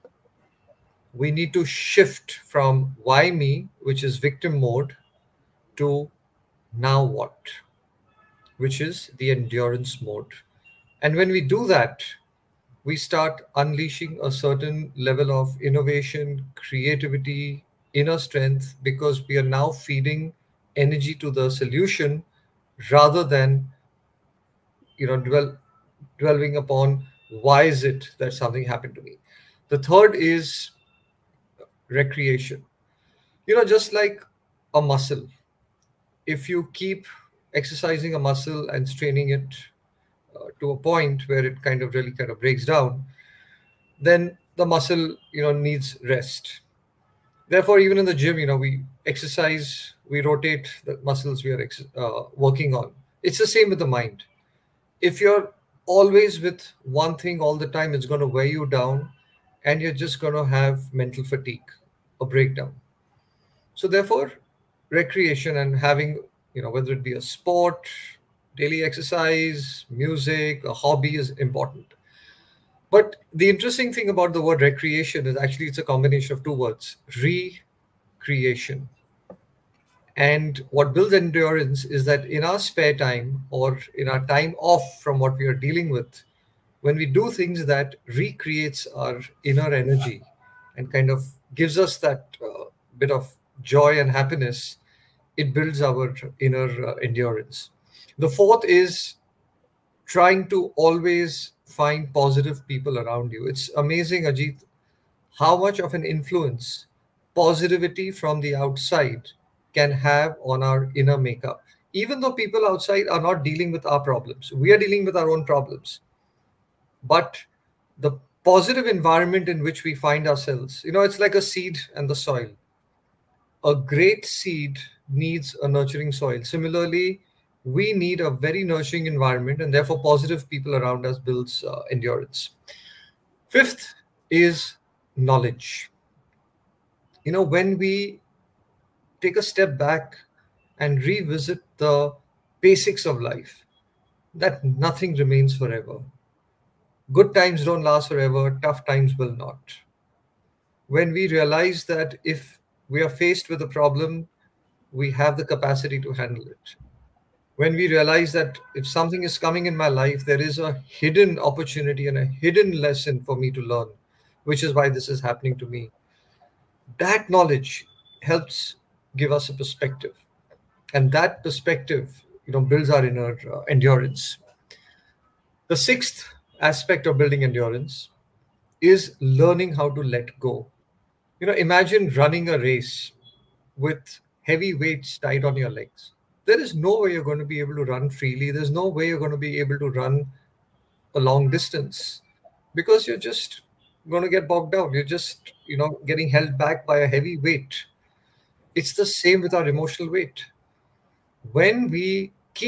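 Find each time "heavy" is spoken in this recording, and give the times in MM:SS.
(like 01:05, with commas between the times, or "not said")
03:04, 03:17.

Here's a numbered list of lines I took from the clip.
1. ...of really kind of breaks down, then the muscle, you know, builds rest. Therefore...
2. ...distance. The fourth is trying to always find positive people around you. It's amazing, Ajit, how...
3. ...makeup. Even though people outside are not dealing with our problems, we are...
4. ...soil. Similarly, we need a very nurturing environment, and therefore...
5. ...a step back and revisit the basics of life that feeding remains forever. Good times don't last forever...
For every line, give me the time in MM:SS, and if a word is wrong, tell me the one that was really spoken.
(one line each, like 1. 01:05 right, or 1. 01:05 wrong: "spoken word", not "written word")
1. 00:41 wrong: "needs", not "builds"
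2. 01:36 wrong: "endurance", not "distance"
3. 01:51 right
4. 02:06 right
5. 02:19 wrong: "nothing", not "feeding".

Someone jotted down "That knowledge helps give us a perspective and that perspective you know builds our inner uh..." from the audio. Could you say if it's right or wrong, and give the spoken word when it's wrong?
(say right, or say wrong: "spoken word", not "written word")
right.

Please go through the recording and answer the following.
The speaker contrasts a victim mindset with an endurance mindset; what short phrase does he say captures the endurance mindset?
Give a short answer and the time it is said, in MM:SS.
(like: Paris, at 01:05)
now what, at 00:06.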